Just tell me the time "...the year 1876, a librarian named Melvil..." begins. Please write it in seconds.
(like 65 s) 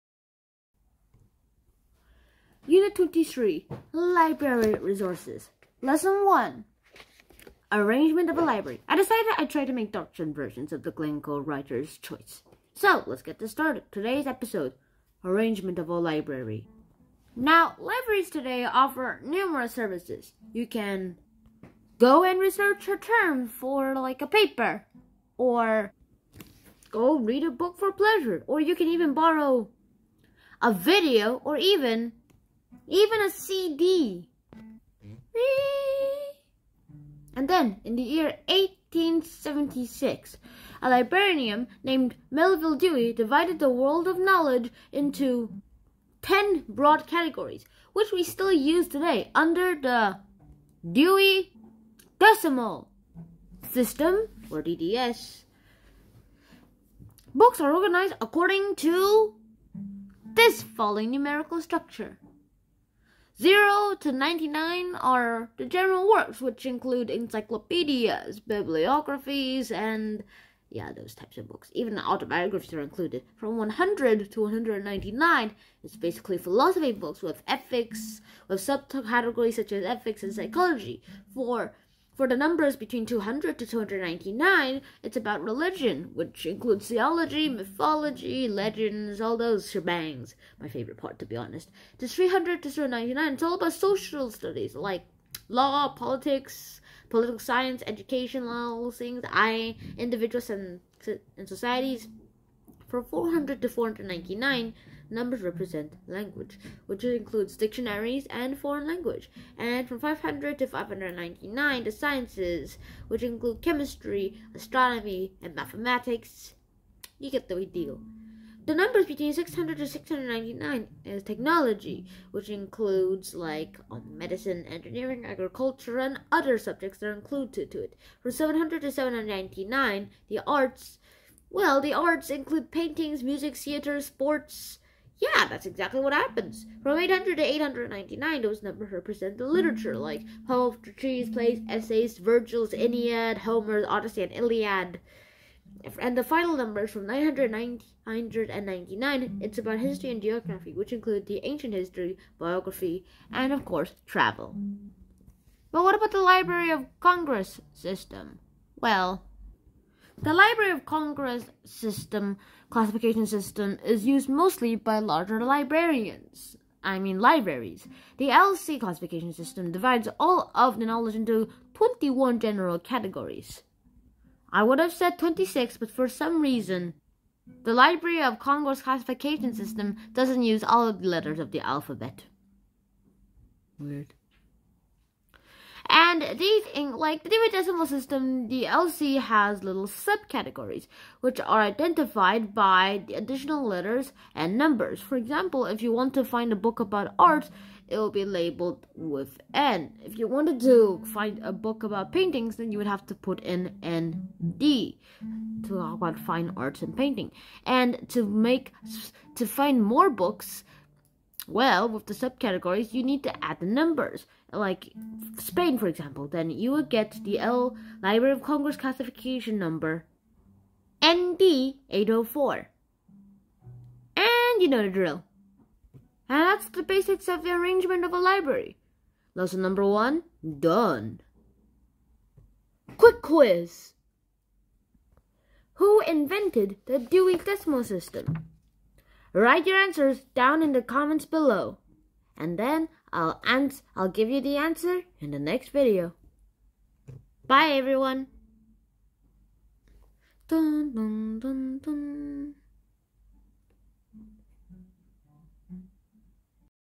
37 s.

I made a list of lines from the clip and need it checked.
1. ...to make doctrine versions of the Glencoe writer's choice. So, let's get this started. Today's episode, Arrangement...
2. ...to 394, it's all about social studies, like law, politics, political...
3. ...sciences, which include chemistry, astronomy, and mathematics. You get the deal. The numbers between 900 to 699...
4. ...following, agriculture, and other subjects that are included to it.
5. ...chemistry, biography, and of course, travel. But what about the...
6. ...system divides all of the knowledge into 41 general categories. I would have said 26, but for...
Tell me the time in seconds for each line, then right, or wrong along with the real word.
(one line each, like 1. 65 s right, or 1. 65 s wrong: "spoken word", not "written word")
1. 9 s right
2. 92 s wrong: "399", not "394"
3. 111 s wrong: "600", not "900"
4. 124 s wrong: "engineering", not "following"
5. 151 s wrong: "history", not "chemistry"
6. 169 s wrong: "21", not "41".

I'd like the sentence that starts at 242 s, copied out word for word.
And then I'll, ans I'll give you the answer in the next video.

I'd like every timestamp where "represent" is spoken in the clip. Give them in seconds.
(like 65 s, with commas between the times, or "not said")
105 s, 138 s.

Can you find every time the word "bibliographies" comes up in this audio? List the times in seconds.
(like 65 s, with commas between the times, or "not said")
68 s.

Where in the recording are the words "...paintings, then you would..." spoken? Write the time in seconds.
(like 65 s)
202 s.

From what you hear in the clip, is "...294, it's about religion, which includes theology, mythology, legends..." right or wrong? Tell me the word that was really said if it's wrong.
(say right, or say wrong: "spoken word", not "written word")
wrong: "299", not "294".